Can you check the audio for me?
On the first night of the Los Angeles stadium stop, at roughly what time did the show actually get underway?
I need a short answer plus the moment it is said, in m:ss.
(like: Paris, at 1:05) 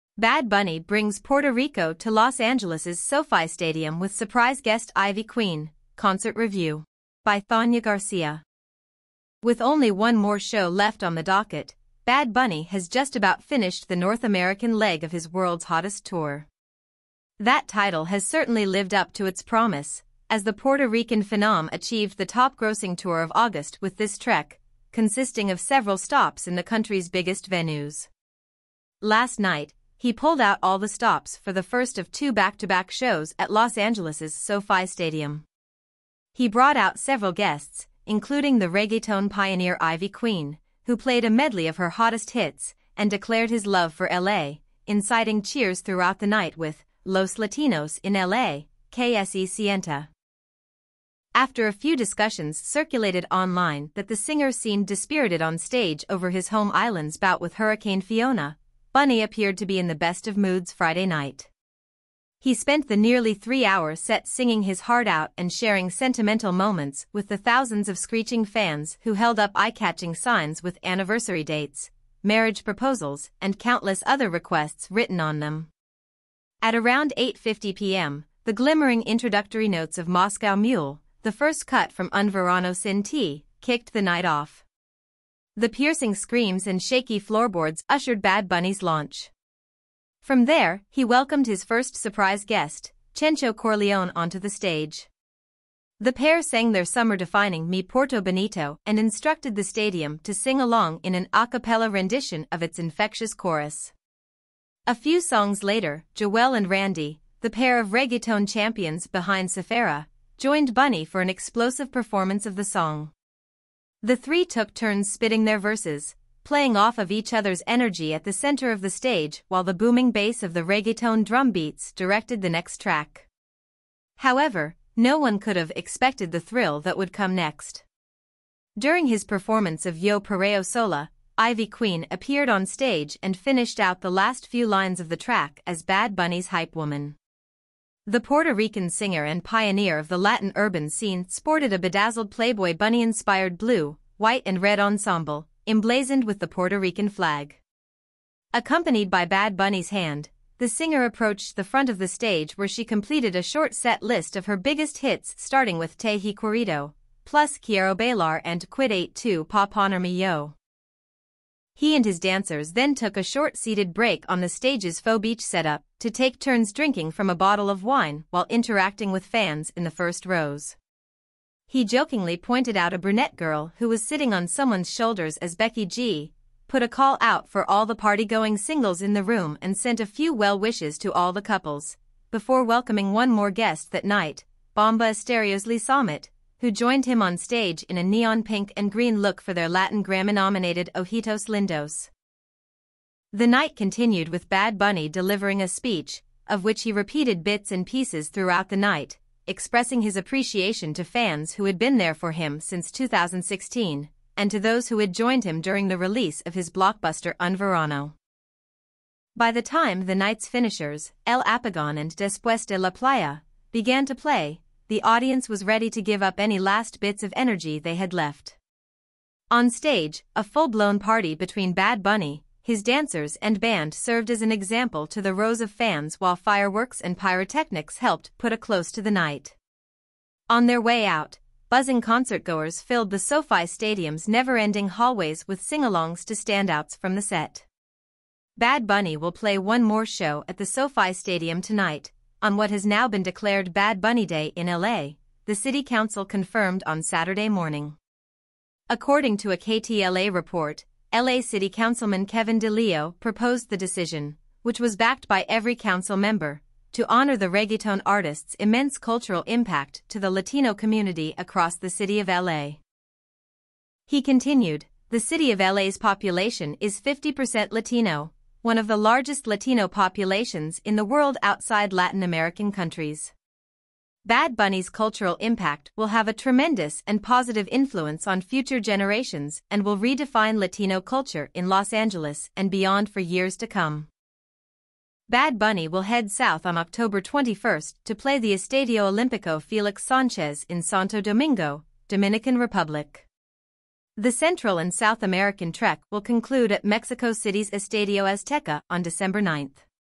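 8:50 p.m., at 1:17.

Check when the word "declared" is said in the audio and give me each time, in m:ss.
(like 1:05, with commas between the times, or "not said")
0:43, 4:03.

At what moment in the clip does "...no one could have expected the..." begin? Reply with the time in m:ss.
2:04.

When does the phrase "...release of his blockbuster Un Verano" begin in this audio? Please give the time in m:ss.
3:25.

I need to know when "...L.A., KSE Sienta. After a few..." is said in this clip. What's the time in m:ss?
0:48.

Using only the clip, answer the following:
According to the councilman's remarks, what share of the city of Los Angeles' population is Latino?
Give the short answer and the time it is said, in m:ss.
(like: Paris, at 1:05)
50%, at 4:26.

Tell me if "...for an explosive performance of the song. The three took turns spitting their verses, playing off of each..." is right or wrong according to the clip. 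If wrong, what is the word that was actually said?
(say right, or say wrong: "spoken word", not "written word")
right.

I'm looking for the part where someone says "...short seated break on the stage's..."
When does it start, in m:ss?
2:43.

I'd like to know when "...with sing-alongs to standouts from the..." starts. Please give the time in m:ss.
3:55.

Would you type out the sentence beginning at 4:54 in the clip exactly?
The Central and South American trek will conclude at Mexico City's Estadio Azteca on December 9th.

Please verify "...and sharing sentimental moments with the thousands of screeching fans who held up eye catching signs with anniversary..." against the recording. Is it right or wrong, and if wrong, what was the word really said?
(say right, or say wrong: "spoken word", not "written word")
right.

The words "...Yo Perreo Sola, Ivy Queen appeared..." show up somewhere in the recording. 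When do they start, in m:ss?
2:09.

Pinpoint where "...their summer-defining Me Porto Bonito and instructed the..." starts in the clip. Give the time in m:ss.
1:36.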